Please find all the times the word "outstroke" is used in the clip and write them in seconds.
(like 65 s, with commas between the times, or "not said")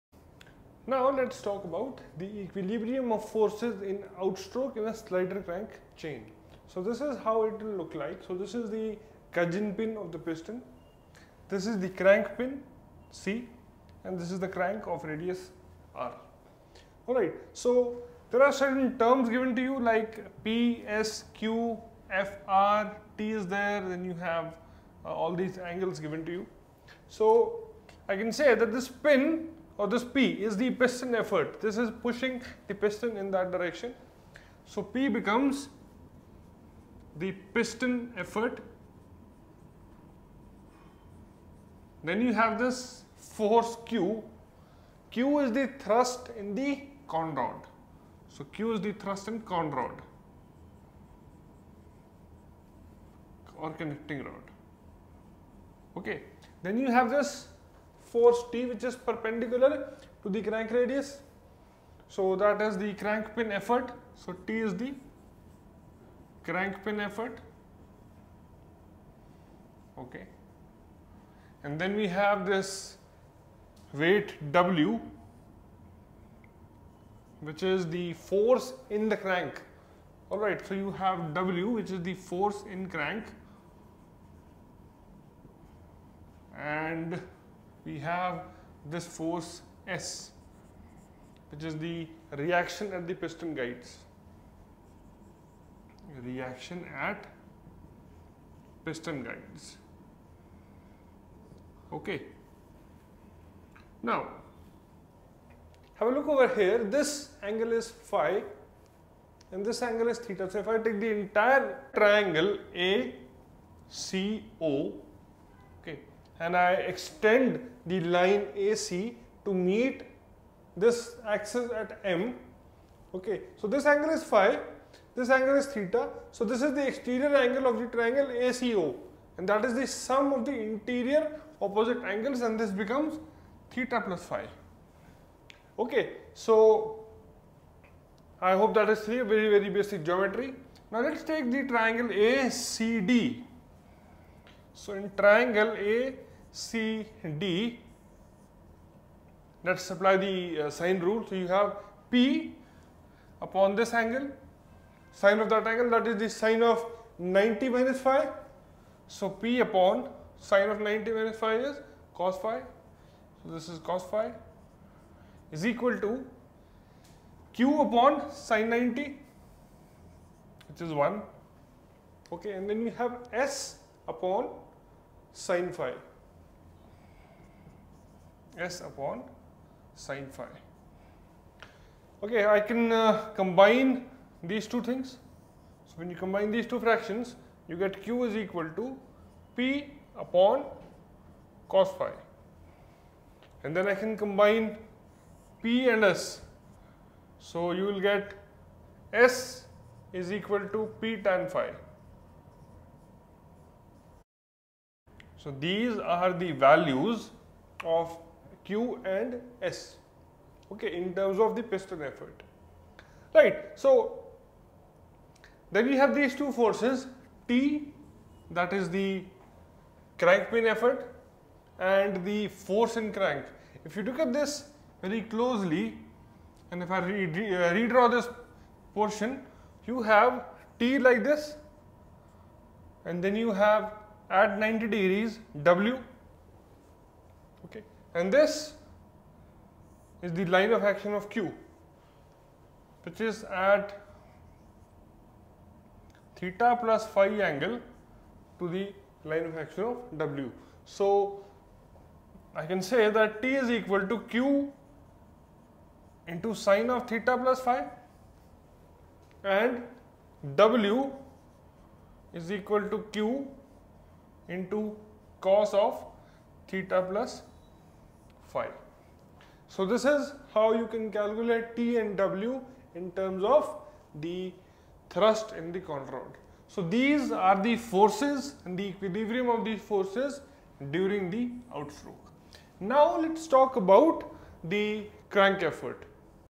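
4 s, 281 s.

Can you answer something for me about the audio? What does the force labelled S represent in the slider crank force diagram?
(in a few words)
Reaction at the piston guides.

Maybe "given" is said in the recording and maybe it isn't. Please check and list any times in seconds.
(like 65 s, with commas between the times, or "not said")
19 s, 25 s.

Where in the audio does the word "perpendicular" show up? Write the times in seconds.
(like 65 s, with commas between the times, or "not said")
59 s.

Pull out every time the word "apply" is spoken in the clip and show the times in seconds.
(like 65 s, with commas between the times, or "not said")
149 s.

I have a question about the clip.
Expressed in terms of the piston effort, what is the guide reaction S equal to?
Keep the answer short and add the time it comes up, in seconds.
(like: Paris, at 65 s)
P tan phi, at 201 s.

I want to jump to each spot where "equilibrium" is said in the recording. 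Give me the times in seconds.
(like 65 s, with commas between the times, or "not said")
2 s, 278 s.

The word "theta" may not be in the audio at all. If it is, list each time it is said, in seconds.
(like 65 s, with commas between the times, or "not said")
110 s, 125 s, 133 s, 246 s, 257 s, 266 s.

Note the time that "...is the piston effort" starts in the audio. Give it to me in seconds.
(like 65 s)
30 s.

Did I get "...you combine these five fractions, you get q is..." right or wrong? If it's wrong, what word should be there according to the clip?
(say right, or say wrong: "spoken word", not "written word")
wrong: "two", not "five".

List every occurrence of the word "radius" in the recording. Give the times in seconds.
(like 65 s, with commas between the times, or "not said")
15 s, 60 s.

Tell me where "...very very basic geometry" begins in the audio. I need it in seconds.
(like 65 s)
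139 s.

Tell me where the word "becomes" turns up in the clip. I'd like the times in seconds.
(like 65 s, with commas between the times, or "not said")
35 s, 132 s.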